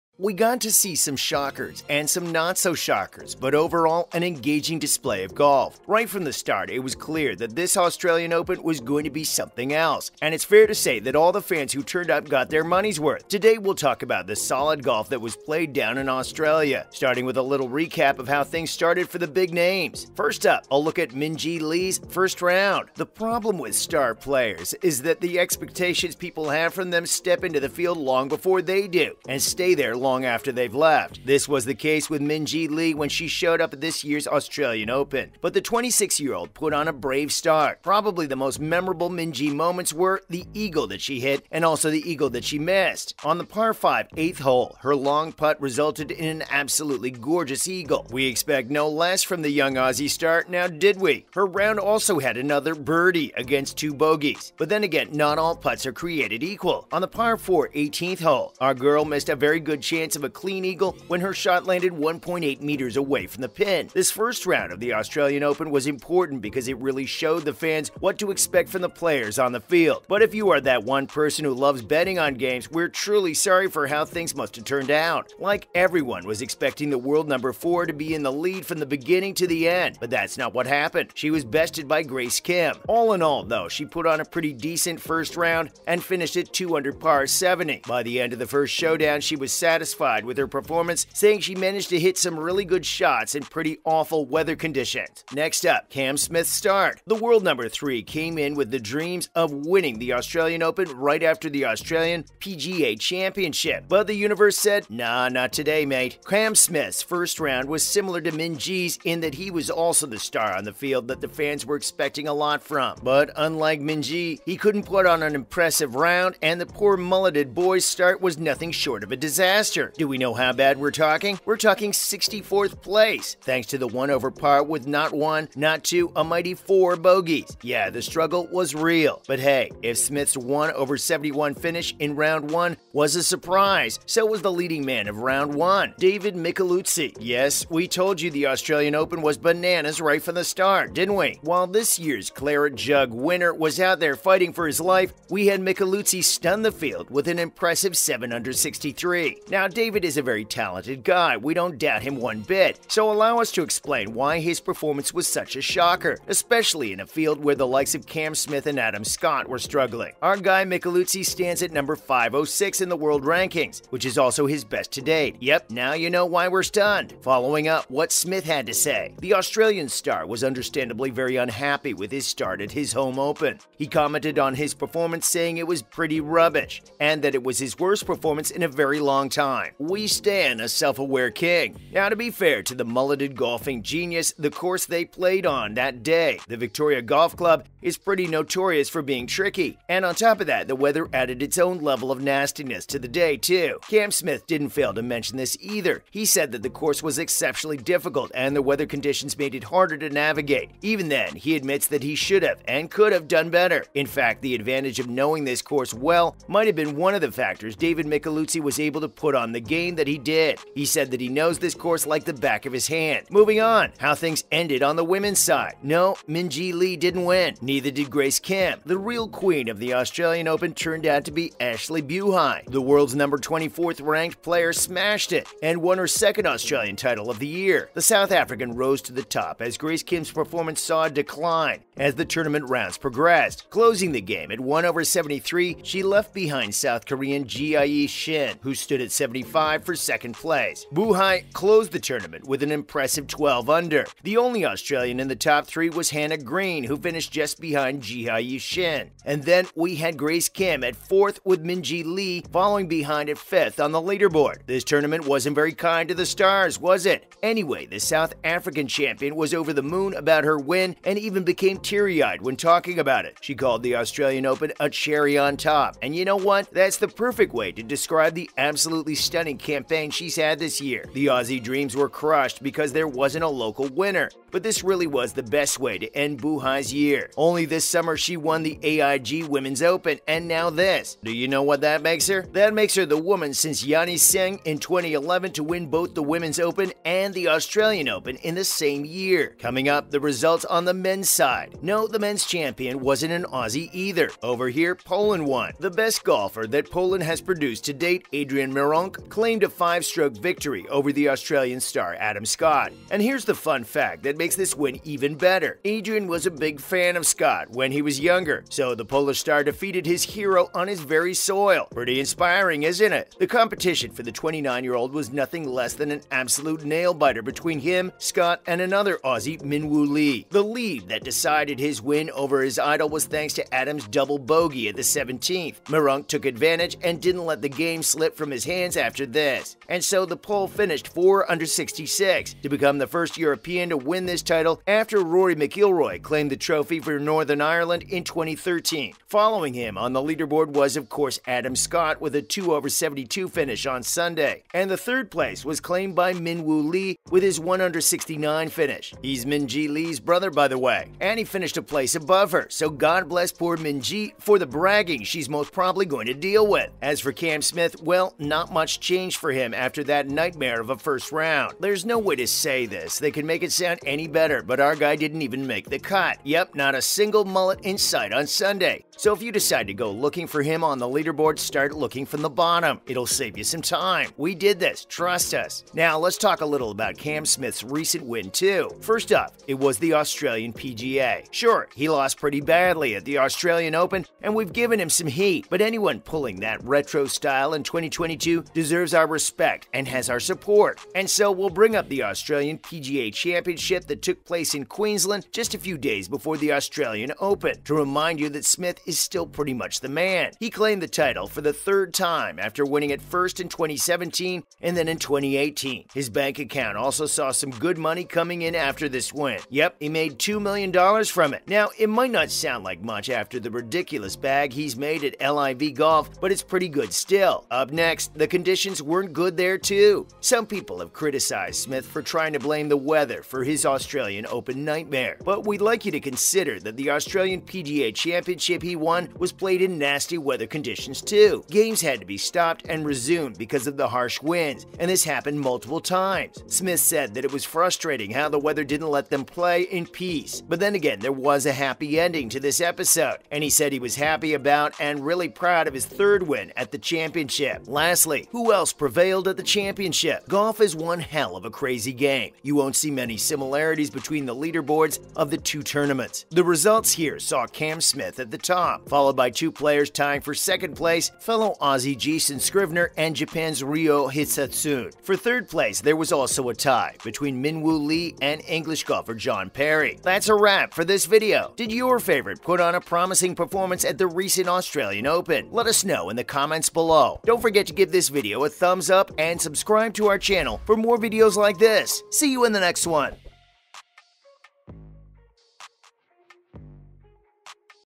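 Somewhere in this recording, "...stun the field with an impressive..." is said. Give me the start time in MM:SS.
02:26.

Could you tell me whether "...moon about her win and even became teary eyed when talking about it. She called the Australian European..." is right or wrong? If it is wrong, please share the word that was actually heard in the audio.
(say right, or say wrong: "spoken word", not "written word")
wrong: "Open", not "European".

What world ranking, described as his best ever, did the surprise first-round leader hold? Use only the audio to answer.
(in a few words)
506.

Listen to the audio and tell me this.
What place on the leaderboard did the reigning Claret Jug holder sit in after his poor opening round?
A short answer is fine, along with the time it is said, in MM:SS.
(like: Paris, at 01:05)
64th, at 02:01.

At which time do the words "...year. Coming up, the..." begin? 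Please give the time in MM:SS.
04:49.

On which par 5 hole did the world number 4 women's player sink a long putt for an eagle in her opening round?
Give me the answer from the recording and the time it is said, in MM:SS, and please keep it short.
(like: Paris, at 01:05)
8th, at 00:44.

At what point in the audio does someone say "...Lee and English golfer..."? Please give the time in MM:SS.
07:48.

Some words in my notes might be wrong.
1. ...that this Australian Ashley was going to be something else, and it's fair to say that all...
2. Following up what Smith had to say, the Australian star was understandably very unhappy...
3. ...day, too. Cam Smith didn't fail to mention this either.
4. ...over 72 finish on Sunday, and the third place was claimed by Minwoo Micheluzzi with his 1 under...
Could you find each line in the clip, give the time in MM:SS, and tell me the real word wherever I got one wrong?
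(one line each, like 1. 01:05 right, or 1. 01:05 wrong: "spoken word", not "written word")
1. 00:07 wrong: "Open", not "Ashley"
2. 02:47 right
3. 03:13 right
4. 05:42 wrong: "Lee", not "Micheluzzi".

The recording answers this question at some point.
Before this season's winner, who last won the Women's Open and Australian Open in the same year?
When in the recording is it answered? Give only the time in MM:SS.
04:43.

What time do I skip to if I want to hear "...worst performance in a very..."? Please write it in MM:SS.
02:57.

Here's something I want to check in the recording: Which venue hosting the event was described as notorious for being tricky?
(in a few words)
Victoria Golf Club.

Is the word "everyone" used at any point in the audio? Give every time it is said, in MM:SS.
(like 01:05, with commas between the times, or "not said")
01:15.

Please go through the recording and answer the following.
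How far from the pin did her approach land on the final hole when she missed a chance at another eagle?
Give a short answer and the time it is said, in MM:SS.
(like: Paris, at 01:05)
1.8 meters, at 01:01.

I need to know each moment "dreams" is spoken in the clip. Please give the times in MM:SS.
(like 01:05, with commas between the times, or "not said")
01:38, 04:31.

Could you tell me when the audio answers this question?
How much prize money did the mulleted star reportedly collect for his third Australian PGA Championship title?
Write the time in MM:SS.
06:50.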